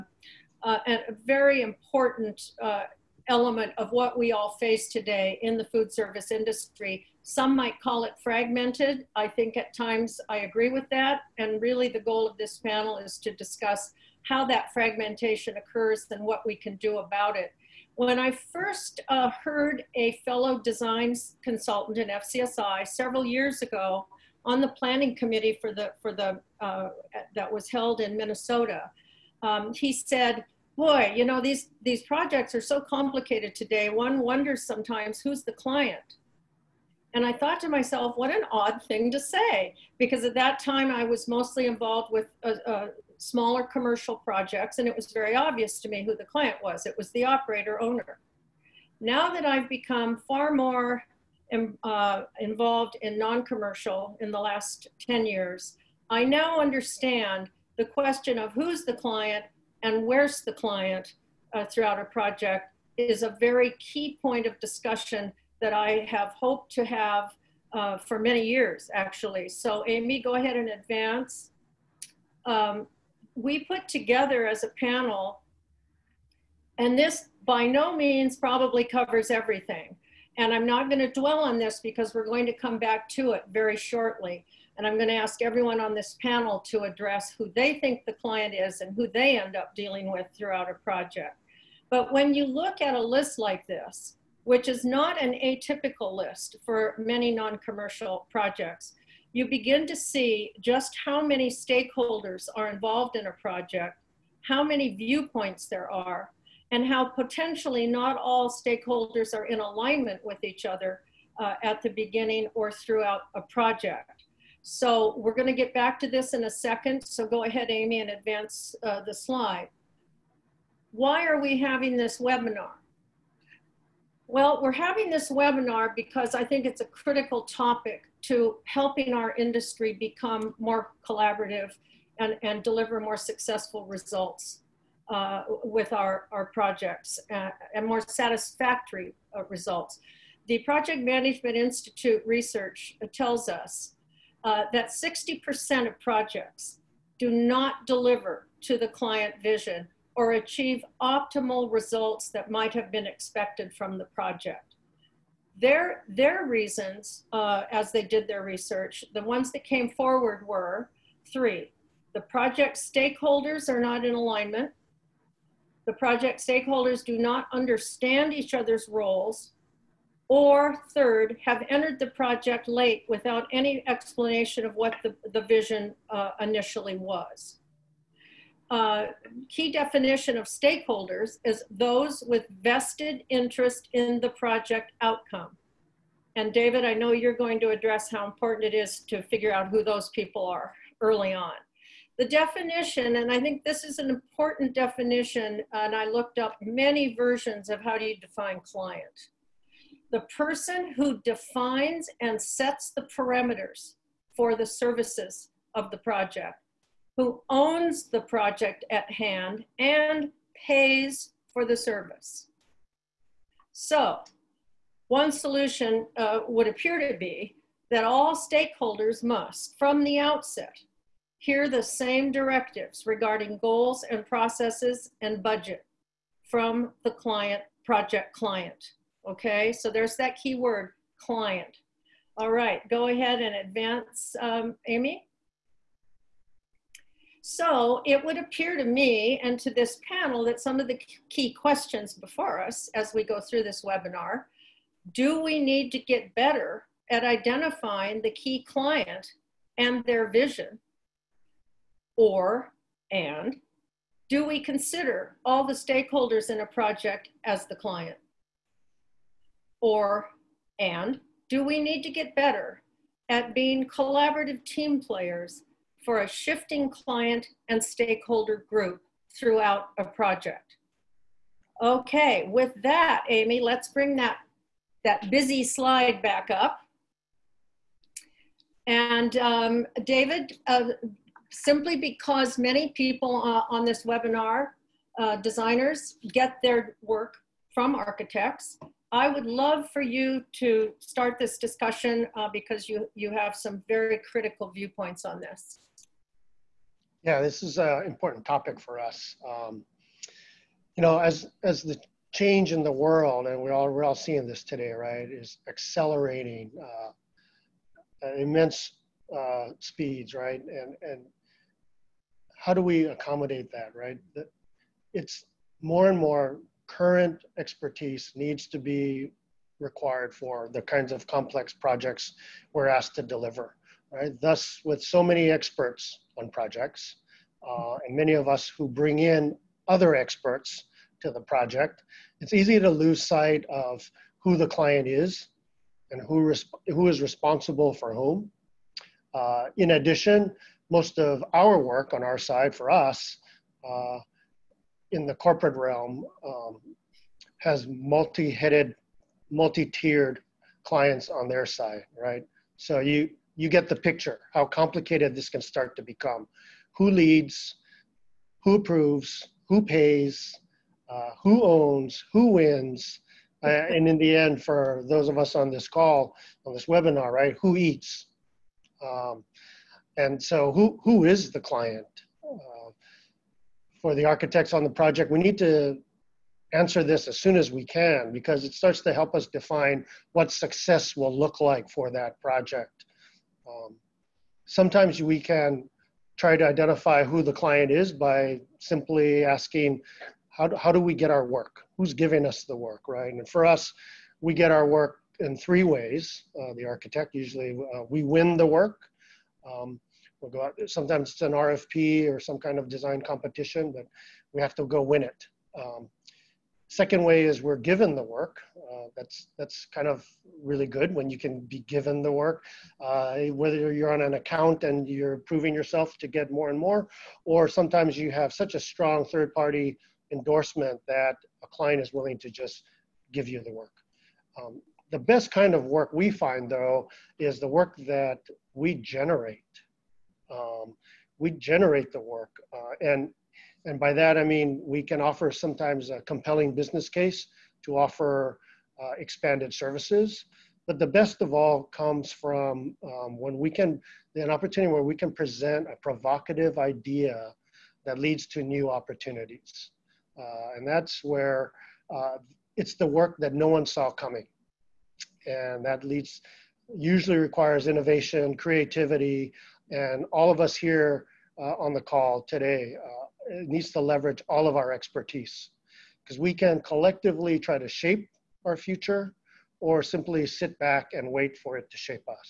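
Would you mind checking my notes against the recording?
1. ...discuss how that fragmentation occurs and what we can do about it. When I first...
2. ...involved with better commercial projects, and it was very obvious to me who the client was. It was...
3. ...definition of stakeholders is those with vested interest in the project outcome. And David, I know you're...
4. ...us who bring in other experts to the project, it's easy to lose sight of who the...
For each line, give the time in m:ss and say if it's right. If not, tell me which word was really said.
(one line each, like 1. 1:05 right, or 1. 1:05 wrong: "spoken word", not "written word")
1. 0:13 right
2. 0:41 wrong: "smaller", not "better"
3. 2:59 right
4. 5:28 right.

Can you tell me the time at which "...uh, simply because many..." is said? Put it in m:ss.
4:40.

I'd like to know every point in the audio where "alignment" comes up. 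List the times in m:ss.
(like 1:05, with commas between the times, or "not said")
1:49, 2:44.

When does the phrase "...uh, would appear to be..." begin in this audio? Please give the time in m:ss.
3:36.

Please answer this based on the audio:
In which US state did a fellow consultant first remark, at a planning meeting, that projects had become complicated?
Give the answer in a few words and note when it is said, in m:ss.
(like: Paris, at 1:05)
Minnesota, at 0:28.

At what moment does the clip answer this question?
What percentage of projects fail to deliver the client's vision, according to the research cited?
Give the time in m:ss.
2:24.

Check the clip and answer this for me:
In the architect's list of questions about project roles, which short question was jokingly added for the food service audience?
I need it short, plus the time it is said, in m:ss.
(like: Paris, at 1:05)
Who eats?, at 6:07.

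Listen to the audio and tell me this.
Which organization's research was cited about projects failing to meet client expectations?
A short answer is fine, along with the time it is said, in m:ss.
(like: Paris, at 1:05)
Project Management Institute, at 2:20.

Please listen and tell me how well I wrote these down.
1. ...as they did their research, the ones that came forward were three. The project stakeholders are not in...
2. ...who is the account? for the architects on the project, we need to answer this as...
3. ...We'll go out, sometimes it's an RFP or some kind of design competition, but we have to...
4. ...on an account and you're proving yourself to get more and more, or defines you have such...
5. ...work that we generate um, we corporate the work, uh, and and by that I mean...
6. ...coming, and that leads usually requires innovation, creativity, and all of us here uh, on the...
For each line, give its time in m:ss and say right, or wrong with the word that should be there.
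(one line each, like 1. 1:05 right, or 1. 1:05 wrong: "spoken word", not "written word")
1. 2:37 right
2. 6:11 wrong: "client", not "account"
3. 6:40 right
4. 6:54 wrong: "sometimes", not "defines"
5. 7:07 wrong: "generate", not "corporate"
6. 7:34 right.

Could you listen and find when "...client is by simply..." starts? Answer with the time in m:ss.
6:27.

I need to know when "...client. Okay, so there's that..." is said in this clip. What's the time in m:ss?
3:48.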